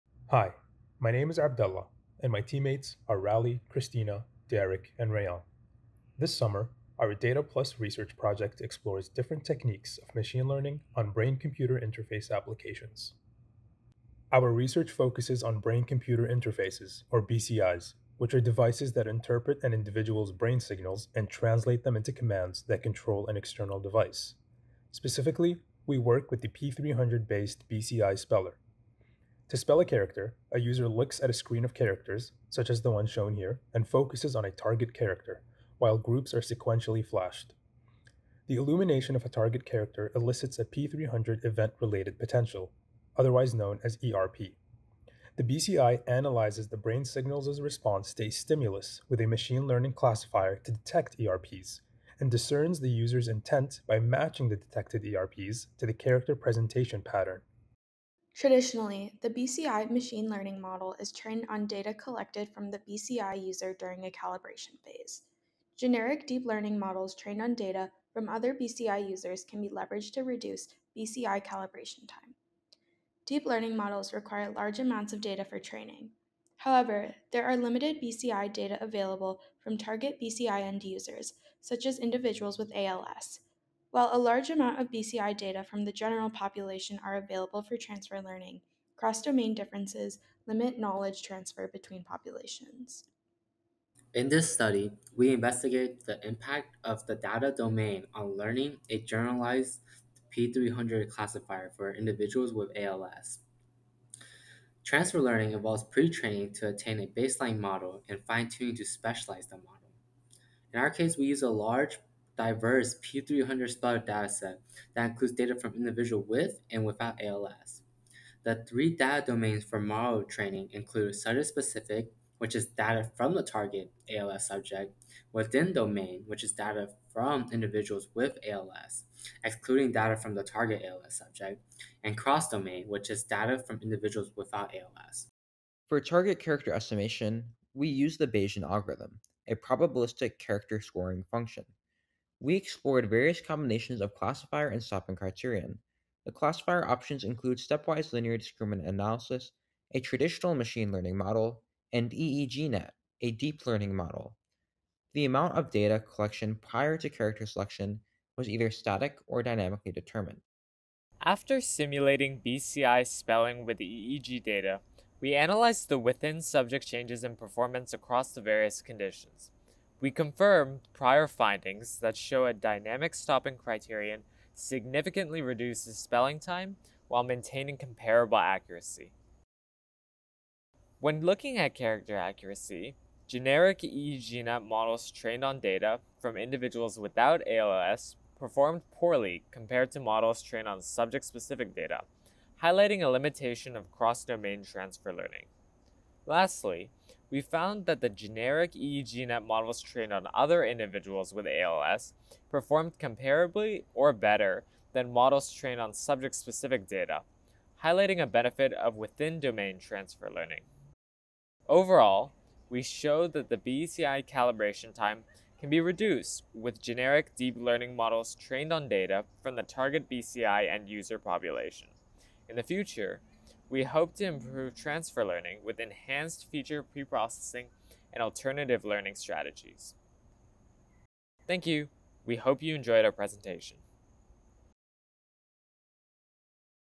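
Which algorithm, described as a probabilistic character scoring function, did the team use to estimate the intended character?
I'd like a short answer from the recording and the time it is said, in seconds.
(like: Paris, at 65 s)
Bayesian algorithm, at 138 s.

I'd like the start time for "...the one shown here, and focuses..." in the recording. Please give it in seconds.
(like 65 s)
32 s.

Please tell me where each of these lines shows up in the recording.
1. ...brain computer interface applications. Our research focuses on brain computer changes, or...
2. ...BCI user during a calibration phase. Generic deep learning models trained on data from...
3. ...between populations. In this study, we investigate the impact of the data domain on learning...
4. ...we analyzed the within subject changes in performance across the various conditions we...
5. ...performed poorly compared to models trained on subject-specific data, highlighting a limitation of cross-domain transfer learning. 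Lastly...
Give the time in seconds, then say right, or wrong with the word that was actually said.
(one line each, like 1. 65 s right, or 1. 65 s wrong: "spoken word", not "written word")
1. 11 s wrong: "interfaces", not "changes"
2. 62 s right
3. 91 s right
4. 165 s right
5. 188 s right.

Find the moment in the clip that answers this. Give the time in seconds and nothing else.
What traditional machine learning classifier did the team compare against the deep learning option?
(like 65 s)
147 s.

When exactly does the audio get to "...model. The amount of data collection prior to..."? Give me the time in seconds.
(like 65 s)
153 s.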